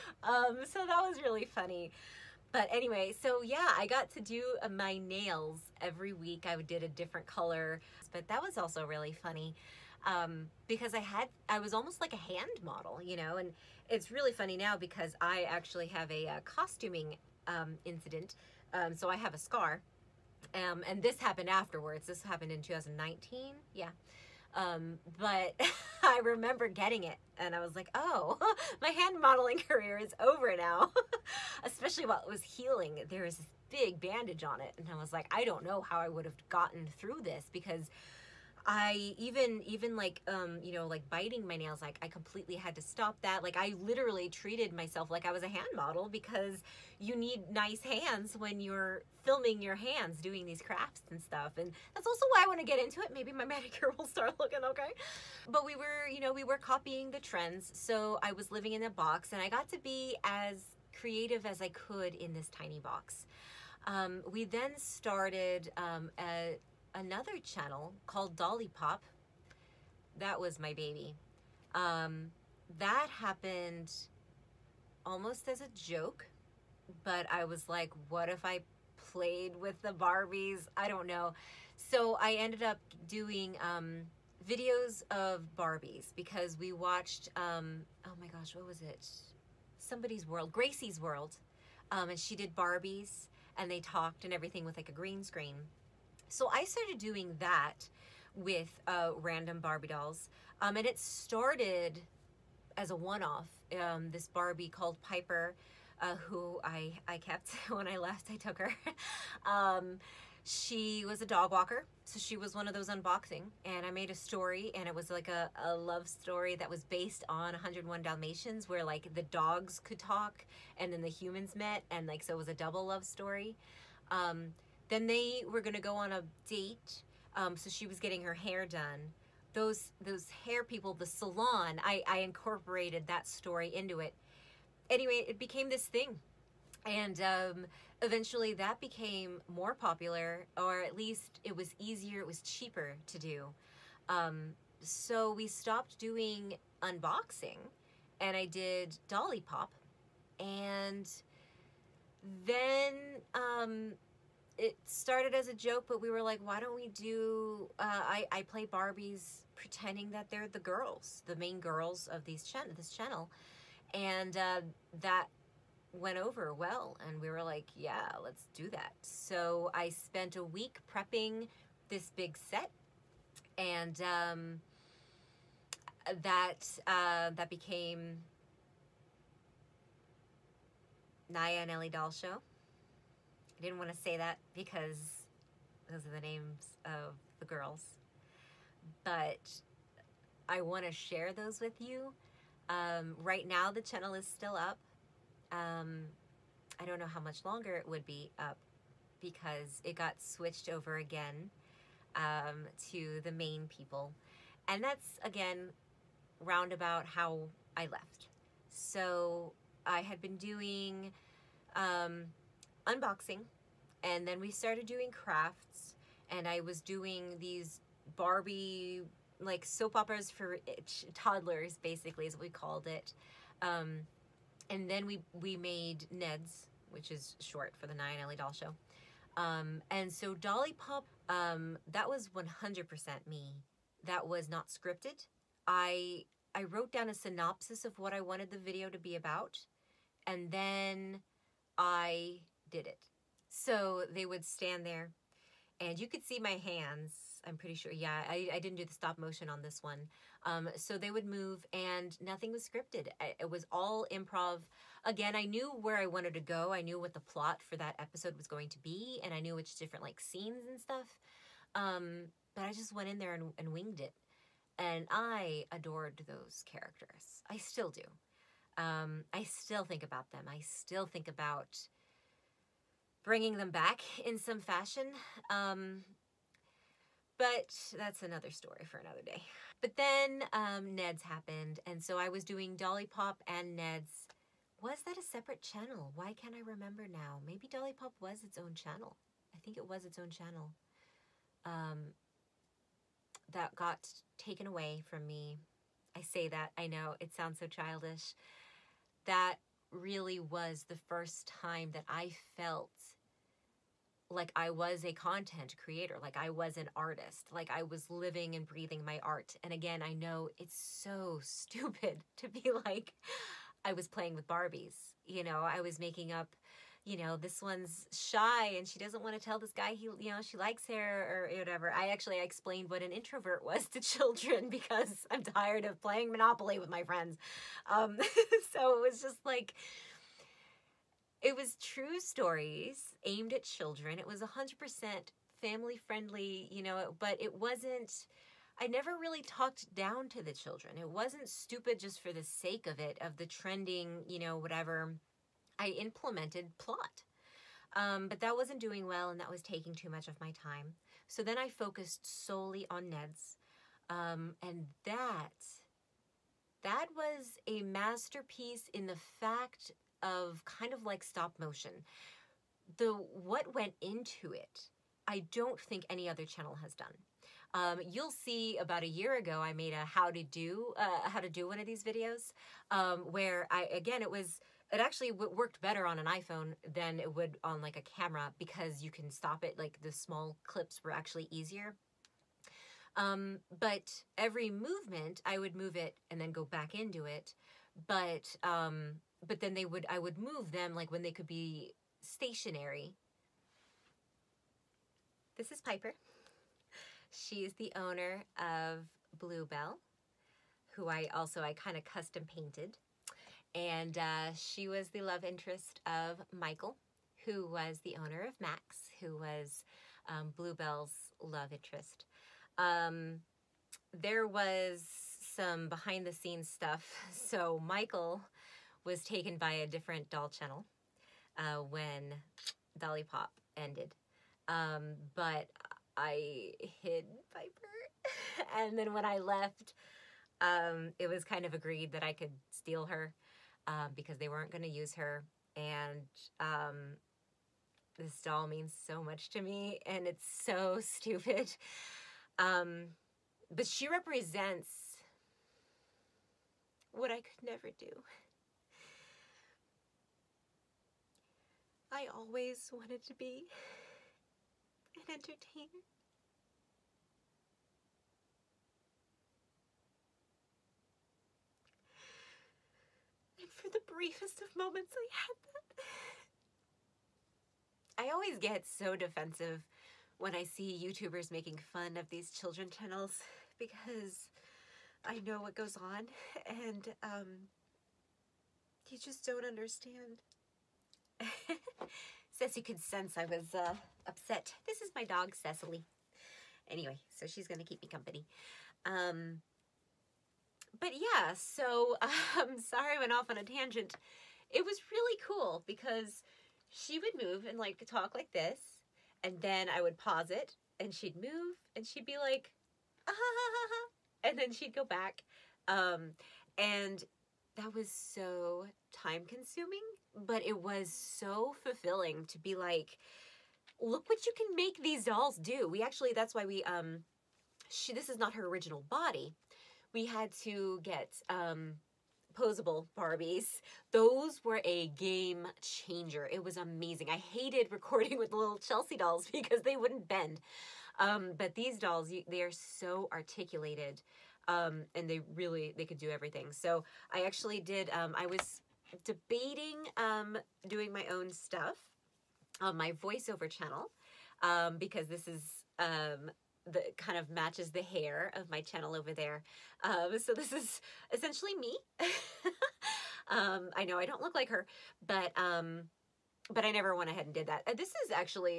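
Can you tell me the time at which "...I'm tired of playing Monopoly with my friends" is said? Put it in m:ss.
5:25.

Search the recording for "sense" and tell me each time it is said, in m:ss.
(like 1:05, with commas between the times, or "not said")
8:03.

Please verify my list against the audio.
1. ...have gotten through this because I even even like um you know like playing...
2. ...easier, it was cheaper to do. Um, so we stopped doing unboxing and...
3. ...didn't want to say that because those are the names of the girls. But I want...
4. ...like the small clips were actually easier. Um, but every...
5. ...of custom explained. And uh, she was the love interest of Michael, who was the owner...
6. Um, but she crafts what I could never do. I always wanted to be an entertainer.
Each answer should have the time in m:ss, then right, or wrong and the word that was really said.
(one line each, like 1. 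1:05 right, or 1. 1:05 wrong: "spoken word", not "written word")
1. 0:36 wrong: "biting", not "playing"
2. 2:21 right
3. 3:03 right
4. 6:19 right
5. 6:41 wrong: "painted", not "explained"
6. 7:22 wrong: "represents", not "crafts".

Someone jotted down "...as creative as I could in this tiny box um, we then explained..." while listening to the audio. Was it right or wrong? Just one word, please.
wrong.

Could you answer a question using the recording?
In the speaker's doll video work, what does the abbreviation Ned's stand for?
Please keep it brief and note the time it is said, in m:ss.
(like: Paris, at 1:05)
Naiah Elli Doll Show, at 3:47.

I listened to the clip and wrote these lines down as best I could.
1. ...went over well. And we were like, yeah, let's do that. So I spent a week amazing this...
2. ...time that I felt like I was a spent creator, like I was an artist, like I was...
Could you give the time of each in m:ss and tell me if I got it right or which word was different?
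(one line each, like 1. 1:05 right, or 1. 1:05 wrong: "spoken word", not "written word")
1. 2:45 wrong: "prepping", not "amazing"
2. 5:01 wrong: "content", not "spent".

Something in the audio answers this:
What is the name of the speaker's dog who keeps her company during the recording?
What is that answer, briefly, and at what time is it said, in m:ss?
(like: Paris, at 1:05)
Cecily, at 8:05.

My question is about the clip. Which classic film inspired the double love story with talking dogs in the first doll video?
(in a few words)
101 Dalmatians.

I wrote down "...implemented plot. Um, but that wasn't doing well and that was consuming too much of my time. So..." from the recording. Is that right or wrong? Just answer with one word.
wrong.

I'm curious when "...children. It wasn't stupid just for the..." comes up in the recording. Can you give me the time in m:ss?
5:40.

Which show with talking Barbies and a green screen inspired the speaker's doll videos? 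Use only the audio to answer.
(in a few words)
Gracie's World.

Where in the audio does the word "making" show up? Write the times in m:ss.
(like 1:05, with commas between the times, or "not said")
5:15, 7:51.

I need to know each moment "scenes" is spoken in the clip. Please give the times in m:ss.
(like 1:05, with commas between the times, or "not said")
4:20, 6:56.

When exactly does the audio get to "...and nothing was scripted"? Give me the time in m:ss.
4:11.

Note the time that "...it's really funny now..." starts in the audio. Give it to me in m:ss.
0:13.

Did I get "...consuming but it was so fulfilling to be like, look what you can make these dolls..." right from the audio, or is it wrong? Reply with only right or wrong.
right.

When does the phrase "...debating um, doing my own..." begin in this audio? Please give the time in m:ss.
8:59.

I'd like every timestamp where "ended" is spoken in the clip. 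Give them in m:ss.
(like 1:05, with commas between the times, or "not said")
1:22, 7:03.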